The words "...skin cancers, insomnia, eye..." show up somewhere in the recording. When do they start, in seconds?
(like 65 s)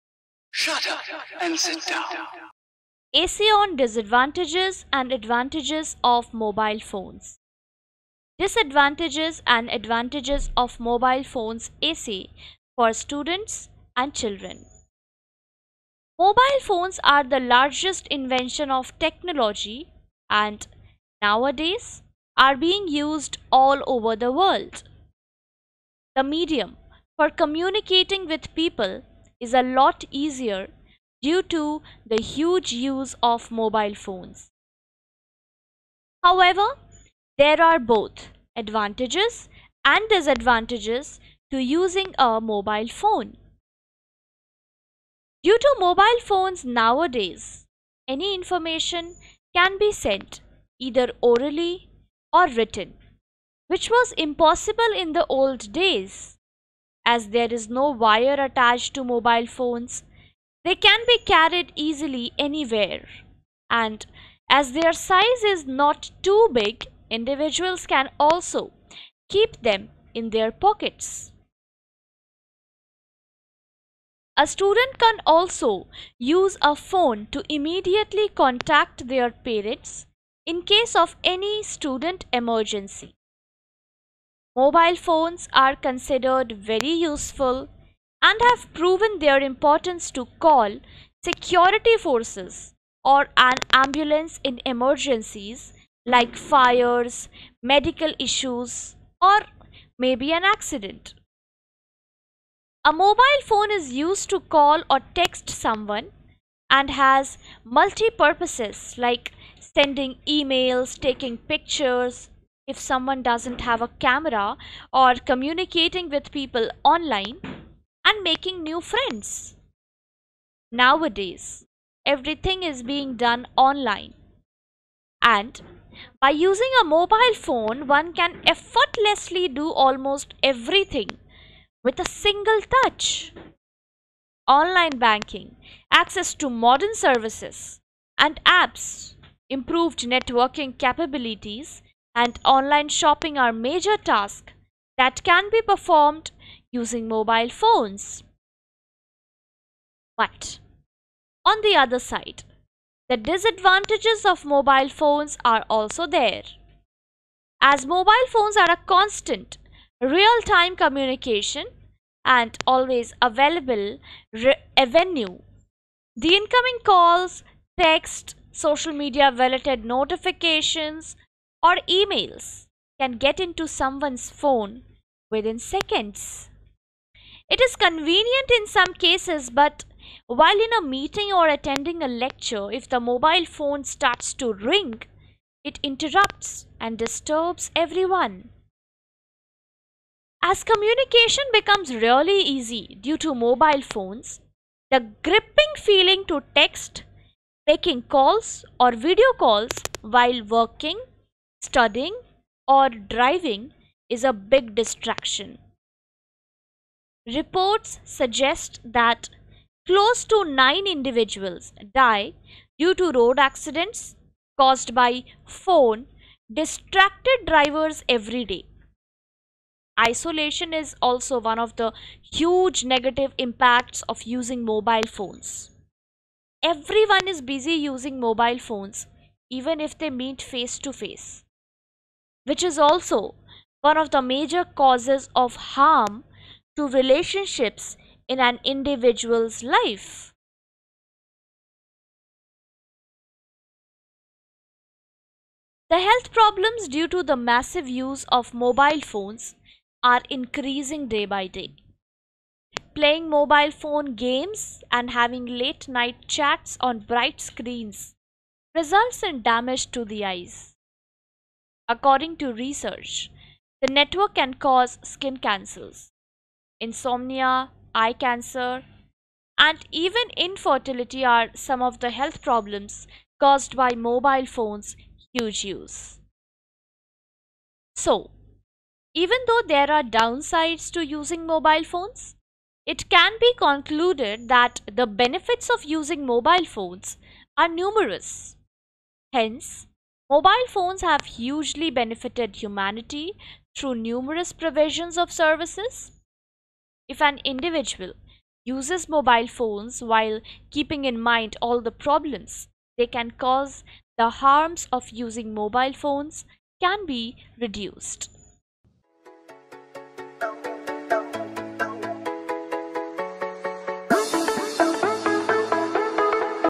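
265 s.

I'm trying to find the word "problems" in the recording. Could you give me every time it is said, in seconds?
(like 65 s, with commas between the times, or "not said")
246 s, 272 s, 302 s.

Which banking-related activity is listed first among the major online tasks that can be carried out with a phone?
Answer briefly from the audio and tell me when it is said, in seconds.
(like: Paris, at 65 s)
Online banking, at 134 s.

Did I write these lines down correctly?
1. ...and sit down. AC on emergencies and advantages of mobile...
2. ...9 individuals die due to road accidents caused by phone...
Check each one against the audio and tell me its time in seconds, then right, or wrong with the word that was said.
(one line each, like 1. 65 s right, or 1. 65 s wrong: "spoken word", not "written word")
1. 1 s wrong: "disadvantages", not "emergencies"
2. 210 s right.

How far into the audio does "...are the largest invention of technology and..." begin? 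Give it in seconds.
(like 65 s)
17 s.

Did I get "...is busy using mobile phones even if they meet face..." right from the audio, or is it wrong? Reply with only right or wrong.
right.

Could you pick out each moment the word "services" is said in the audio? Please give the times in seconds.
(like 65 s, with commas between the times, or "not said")
136 s, 295 s.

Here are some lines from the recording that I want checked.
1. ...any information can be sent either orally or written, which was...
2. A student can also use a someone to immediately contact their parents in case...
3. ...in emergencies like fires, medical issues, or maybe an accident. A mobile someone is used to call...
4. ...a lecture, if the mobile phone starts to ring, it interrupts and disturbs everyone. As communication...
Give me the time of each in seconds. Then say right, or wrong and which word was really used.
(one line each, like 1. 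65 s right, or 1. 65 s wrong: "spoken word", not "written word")
1. 48 s right
2. 74 s wrong: "phone", not "someone"
3. 94 s wrong: "phone", not "someone"
4. 182 s right.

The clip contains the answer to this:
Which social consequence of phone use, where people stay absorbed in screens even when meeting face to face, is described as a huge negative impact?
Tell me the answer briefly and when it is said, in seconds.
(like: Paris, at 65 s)
Isolation, at 219 s.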